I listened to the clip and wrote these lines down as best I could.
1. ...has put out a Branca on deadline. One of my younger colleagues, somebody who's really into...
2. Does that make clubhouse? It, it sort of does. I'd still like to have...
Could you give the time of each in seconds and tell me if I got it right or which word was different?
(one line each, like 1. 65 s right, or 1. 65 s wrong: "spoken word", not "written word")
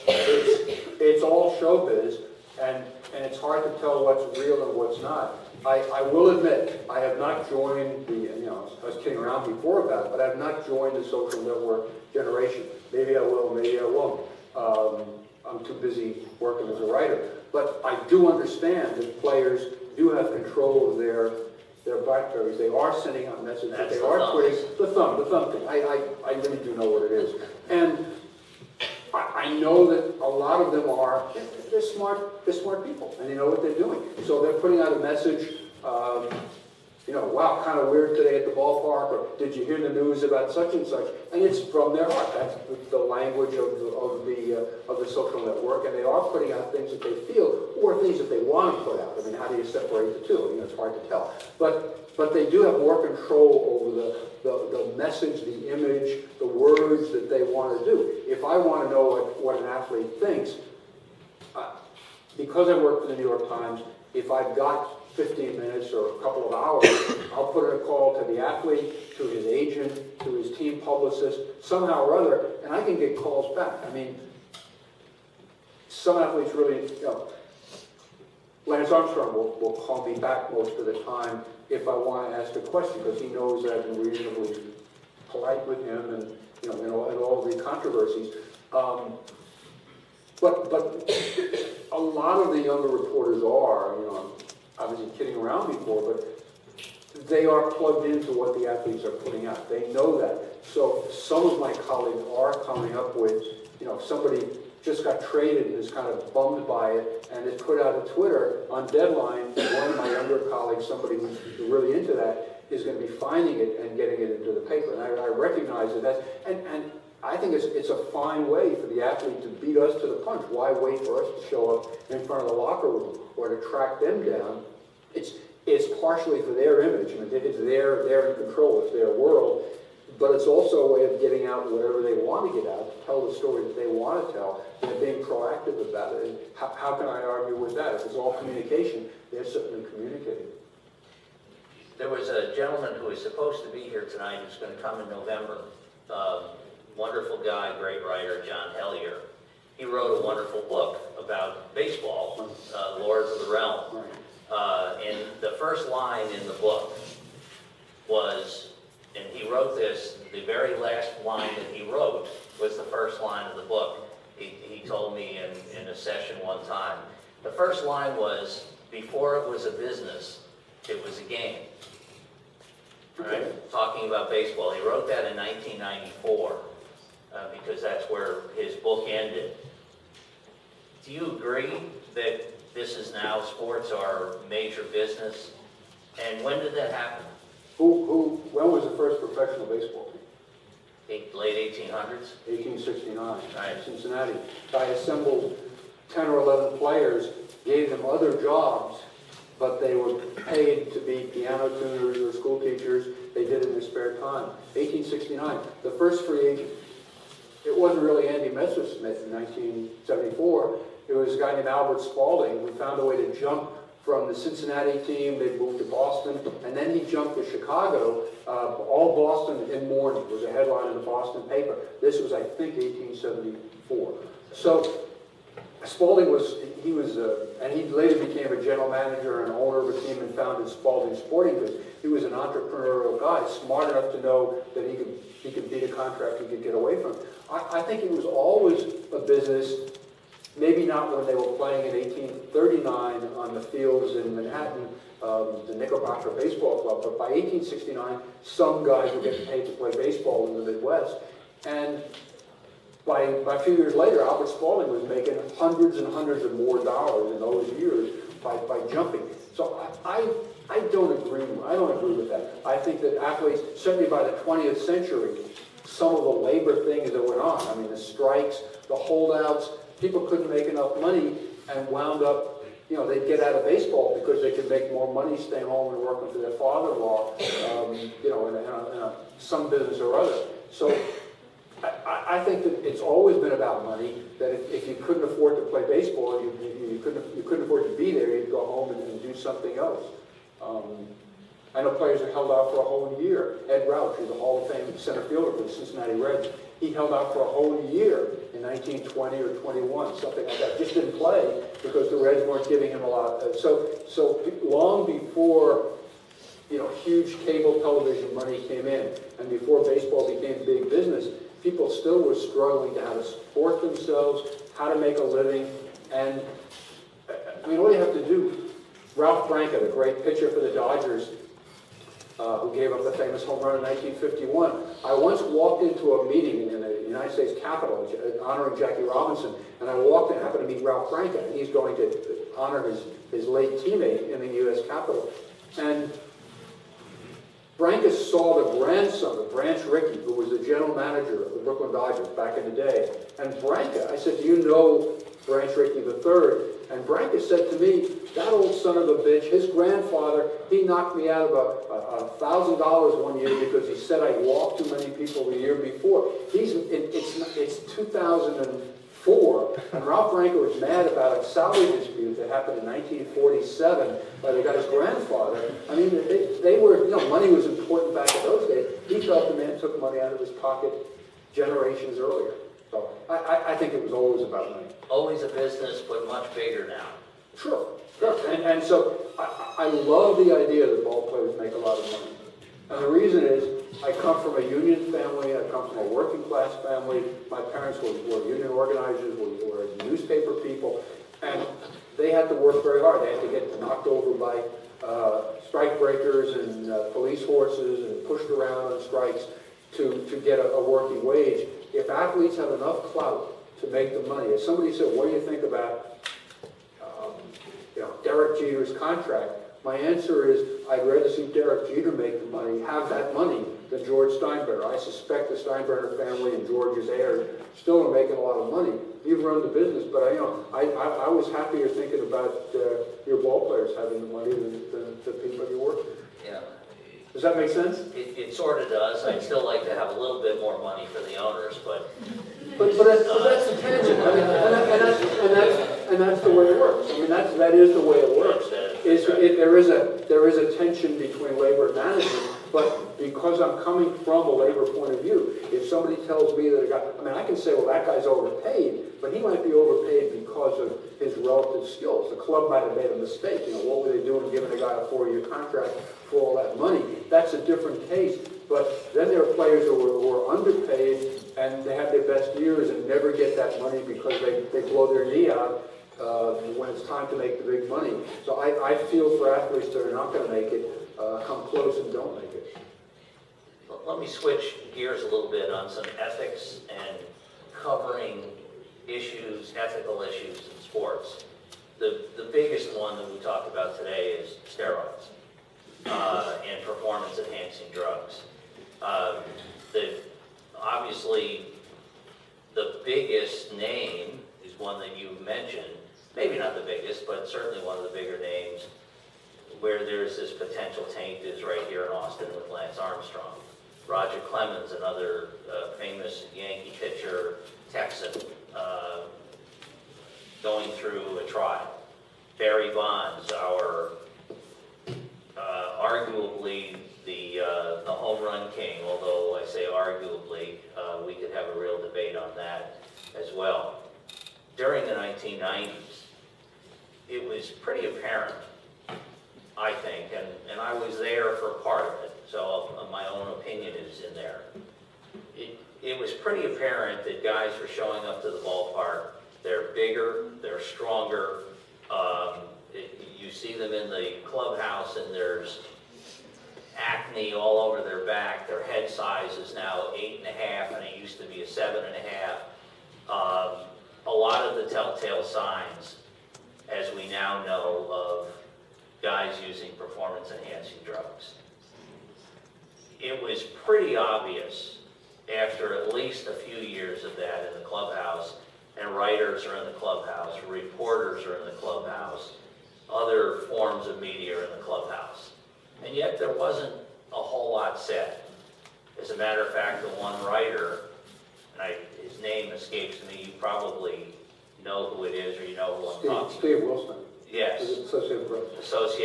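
1. 107 s wrong: "Twitter", not "Branca"
2. 427 s wrong: "sense", not "clubhouse".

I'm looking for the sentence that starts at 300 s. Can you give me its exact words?
Just didn't play because the Reds weren't giving him a lot.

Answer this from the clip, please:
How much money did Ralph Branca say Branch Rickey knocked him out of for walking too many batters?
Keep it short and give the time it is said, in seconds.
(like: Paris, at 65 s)
$1,000, at 351 s.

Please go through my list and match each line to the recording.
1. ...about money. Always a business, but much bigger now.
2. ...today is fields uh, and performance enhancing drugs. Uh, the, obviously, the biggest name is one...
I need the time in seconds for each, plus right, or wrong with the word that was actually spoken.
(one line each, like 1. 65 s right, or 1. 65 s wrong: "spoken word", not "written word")
1. 374 s right
2. 483 s wrong: "steroids", not "fields".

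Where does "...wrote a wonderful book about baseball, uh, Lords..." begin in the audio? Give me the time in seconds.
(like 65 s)
149 s.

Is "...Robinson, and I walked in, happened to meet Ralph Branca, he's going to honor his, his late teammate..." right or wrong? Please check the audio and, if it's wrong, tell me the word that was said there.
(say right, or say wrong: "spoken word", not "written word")
right.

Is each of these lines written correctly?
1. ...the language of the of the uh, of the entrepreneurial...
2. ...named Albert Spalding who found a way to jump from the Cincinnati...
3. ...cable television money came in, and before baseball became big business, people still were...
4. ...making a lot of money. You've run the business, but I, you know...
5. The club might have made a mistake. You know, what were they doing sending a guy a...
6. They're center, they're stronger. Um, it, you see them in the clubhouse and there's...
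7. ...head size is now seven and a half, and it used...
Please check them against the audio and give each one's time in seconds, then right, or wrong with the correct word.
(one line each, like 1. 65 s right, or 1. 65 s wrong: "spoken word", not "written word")
1. 42 s wrong: "social", not "entrepreneurial"
2. 211 s right
3. 307 s right
4. 418 s right
5. 452 s wrong: "giving", not "sending"
6. 539 s wrong: "bigger", not "center"
7. 548 s wrong: "eight", not "seven".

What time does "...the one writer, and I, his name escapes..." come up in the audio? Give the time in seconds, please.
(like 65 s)
580 s.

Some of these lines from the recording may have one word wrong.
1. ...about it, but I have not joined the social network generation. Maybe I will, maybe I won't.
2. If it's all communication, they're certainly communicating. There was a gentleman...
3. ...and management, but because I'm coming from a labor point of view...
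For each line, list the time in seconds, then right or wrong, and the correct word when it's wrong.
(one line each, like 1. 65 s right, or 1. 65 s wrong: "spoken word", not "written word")
1. 9 s right
2. 137 s right
3. 441 s right.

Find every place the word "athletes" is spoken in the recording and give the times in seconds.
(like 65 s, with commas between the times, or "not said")
59 s, 68 s, 76 s, 98 s, 119 s, 263 s, 402 s, 469 s.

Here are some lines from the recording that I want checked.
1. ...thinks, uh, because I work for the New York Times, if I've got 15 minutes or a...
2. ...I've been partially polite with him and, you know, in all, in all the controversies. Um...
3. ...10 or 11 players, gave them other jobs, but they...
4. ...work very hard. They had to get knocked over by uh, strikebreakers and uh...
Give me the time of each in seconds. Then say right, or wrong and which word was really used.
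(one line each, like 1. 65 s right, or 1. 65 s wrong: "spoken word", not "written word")
1. 60 s right
2. 83 s wrong: "reasonably", not "partially"
3. 196 s right
4. 392 s right.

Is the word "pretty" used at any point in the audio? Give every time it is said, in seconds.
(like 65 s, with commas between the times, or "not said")
527 s, 536 s, 563 s.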